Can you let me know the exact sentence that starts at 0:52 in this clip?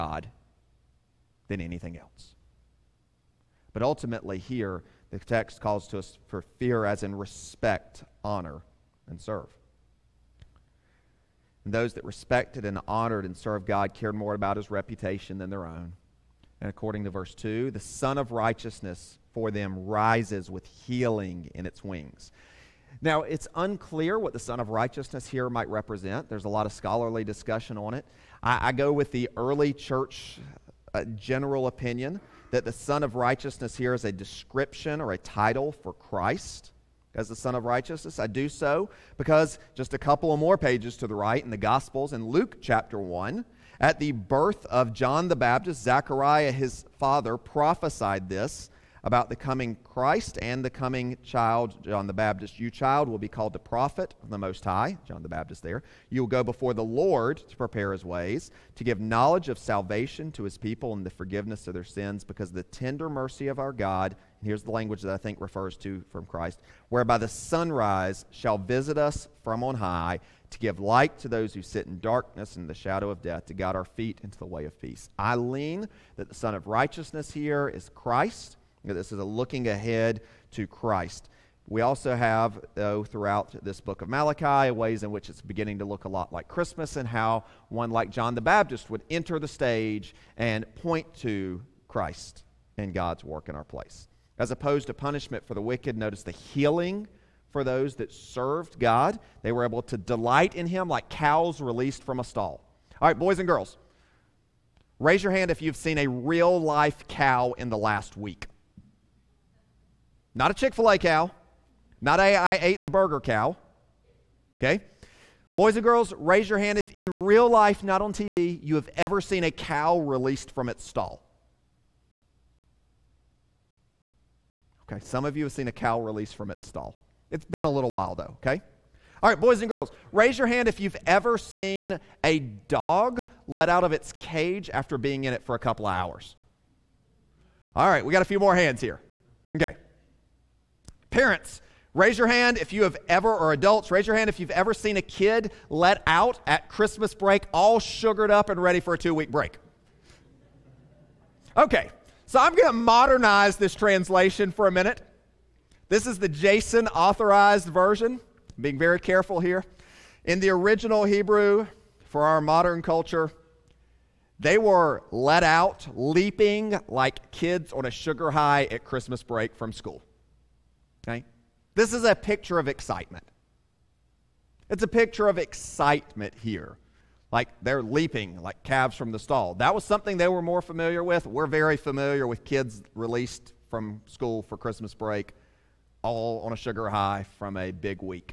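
You, child, will be called the prophet of the Most High, John the Baptist there.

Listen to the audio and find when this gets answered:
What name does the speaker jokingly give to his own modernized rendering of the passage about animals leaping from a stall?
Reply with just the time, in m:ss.
2:36.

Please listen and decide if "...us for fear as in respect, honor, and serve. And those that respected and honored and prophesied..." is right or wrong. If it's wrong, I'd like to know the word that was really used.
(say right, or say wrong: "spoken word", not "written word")
wrong: "served", not "prophesied".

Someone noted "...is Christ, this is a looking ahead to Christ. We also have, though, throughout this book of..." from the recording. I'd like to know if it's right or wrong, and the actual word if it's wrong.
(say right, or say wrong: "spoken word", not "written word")
right.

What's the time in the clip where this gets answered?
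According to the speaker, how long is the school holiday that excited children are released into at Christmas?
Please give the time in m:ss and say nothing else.
2:28.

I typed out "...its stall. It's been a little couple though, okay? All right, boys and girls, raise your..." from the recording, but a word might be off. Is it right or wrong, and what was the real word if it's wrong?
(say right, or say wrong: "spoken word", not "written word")
wrong: "while", not "couple".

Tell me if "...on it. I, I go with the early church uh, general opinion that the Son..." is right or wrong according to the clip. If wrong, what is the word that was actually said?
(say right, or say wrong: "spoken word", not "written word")
right.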